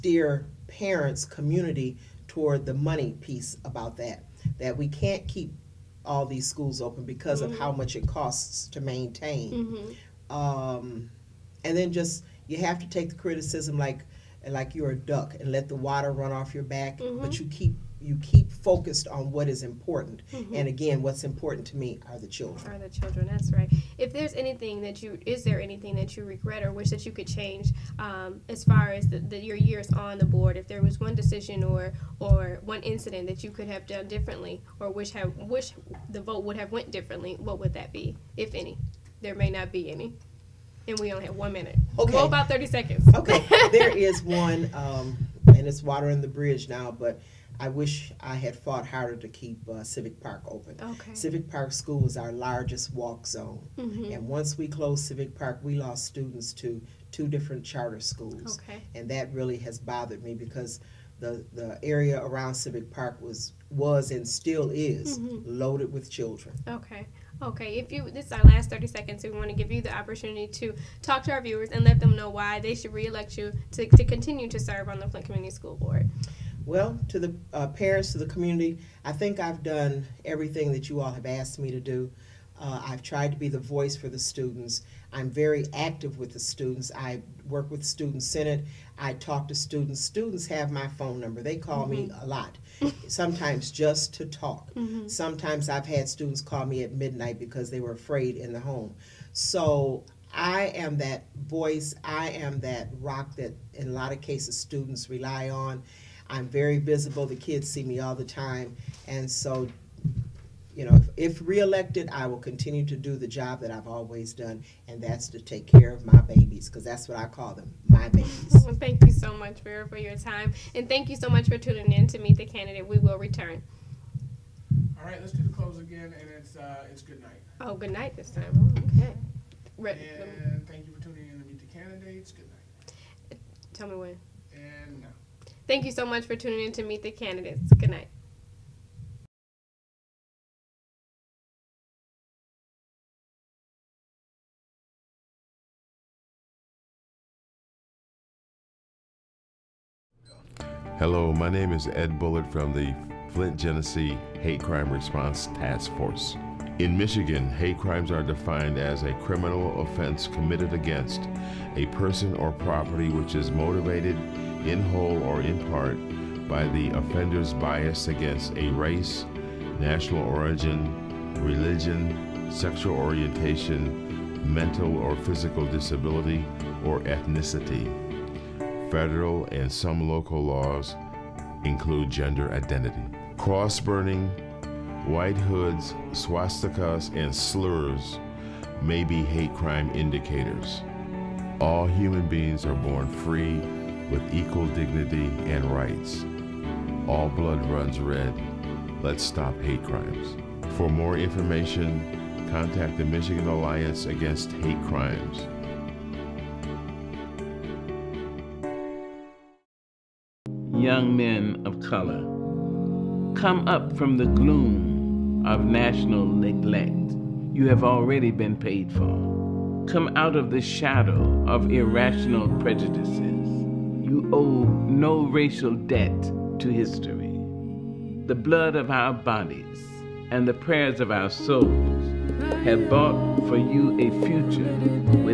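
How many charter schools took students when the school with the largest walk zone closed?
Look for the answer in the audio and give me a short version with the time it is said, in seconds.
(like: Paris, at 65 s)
2, at 57 s.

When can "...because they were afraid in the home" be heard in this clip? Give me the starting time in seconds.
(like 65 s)
97 s.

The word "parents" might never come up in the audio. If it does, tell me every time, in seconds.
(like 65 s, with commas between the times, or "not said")
0 s, 77 s.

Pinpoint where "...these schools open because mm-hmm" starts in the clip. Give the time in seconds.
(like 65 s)
6 s.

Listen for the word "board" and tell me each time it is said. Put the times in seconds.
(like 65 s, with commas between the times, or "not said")
30 s, 75 s.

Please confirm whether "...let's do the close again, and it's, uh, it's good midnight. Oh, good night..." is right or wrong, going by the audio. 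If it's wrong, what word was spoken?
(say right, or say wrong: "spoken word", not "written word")
wrong: "night", not "midnight".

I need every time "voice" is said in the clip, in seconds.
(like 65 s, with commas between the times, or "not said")
83 s, 101 s.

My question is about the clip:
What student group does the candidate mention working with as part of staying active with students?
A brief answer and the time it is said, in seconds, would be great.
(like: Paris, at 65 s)
Student Senate, at 87 s.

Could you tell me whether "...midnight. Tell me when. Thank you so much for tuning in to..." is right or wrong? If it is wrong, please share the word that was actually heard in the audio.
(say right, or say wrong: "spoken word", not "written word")
wrong: "night", not "midnight".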